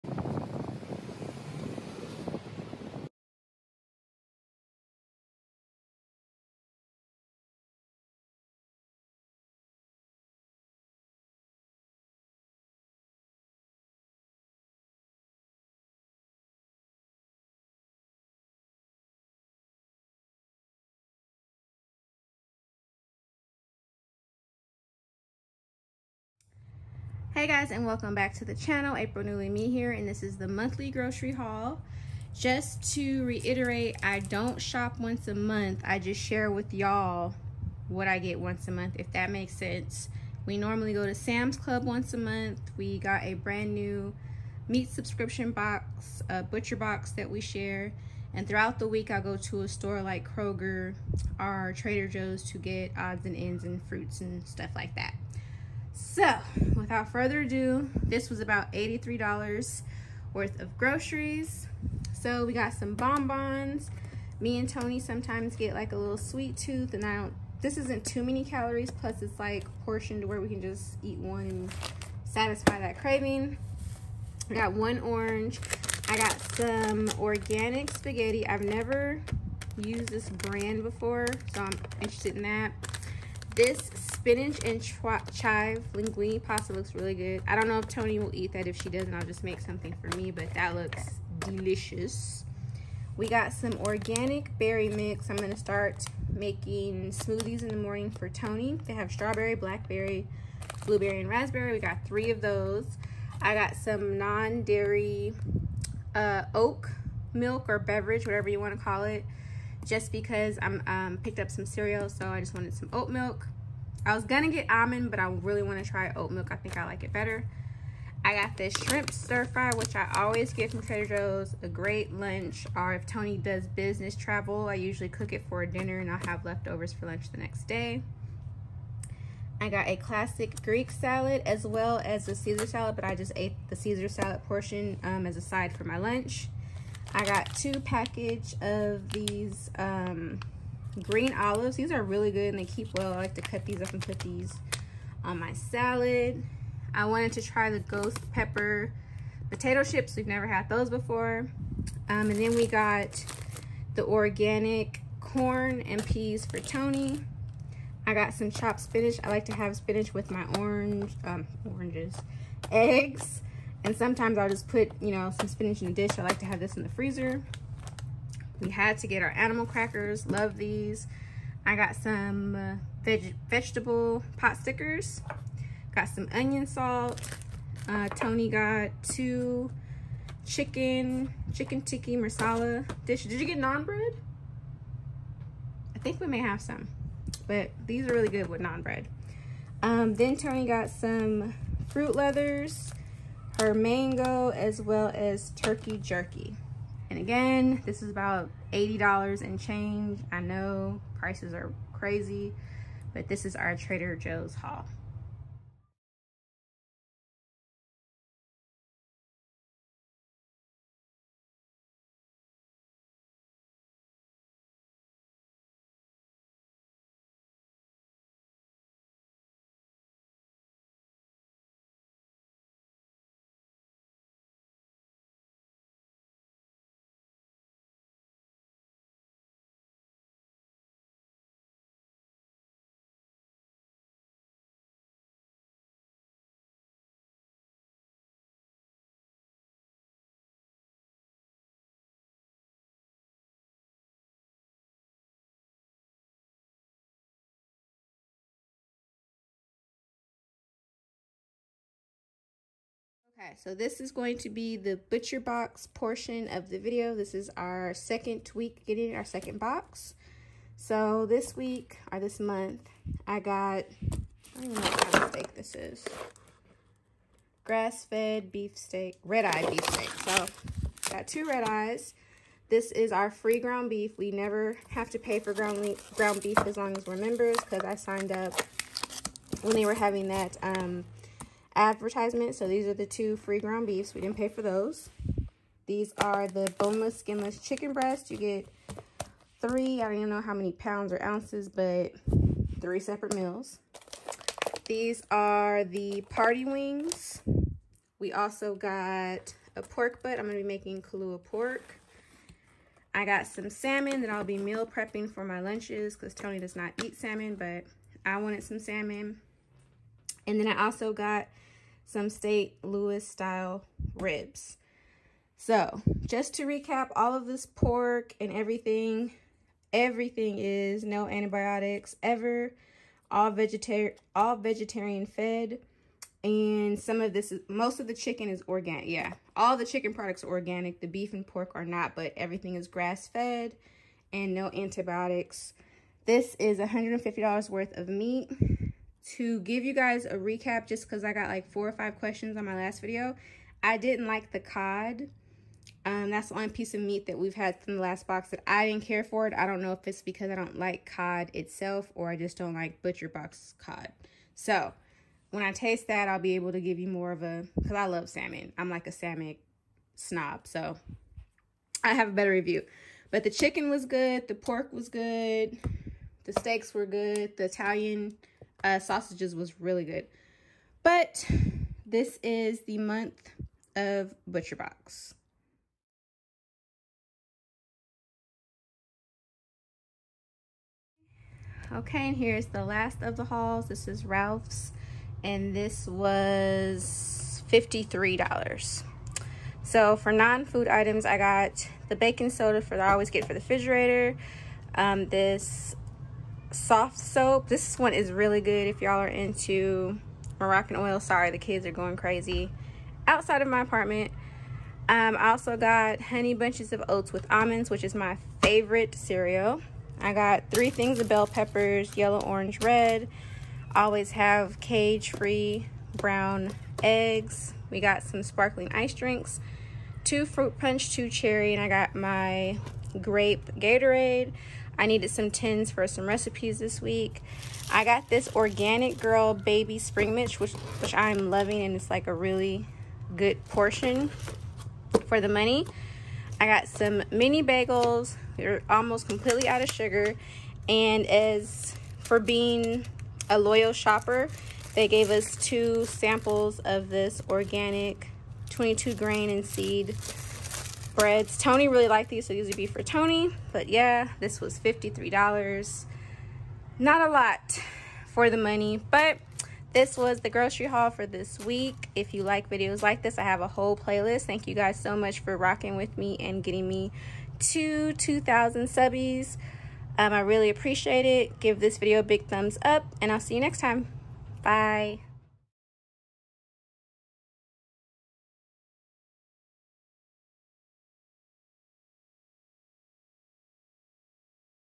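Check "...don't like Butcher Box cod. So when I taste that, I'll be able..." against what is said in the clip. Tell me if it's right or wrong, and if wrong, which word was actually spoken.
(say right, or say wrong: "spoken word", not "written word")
right.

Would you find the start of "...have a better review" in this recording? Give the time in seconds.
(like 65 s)
362 s.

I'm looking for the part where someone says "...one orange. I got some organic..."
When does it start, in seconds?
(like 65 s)
74 s.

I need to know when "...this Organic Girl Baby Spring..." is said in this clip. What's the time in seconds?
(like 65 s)
428 s.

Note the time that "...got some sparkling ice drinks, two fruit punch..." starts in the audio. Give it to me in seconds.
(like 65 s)
417 s.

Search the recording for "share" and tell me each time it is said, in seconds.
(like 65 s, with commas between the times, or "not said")
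36 s, 47 s.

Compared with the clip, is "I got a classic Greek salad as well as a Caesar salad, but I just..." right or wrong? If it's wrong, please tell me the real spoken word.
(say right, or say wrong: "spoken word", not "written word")
right.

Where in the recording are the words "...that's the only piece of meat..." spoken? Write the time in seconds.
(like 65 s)
346 s.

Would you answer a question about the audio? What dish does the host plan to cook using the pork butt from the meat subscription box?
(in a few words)
Kalua pork.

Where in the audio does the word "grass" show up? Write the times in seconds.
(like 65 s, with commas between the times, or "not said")
267 s, 332 s.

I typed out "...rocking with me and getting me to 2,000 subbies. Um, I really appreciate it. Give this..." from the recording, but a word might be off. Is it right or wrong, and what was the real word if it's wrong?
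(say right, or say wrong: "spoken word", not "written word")
right.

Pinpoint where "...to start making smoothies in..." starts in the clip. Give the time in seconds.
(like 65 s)
95 s.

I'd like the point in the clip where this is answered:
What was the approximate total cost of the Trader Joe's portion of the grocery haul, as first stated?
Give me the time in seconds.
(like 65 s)
58 s.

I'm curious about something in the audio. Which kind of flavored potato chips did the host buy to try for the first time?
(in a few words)
ghost pepper.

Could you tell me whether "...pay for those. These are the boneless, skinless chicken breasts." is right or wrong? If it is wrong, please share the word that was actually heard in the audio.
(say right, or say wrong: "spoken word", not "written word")
right.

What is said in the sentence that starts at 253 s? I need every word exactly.
Okay, so this is going to be the butcher box portion of the video.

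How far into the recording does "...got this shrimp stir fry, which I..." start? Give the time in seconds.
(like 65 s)
118 s.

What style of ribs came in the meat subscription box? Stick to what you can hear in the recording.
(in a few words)
St. Louis style.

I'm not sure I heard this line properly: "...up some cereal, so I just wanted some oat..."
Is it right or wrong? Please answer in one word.
right.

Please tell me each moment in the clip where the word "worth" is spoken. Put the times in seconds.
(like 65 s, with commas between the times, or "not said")
60 s, 337 s.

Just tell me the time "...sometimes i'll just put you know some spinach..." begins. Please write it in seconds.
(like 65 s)
163 s.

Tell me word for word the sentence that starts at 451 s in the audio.
Tony really liked these, so these would be for Tony.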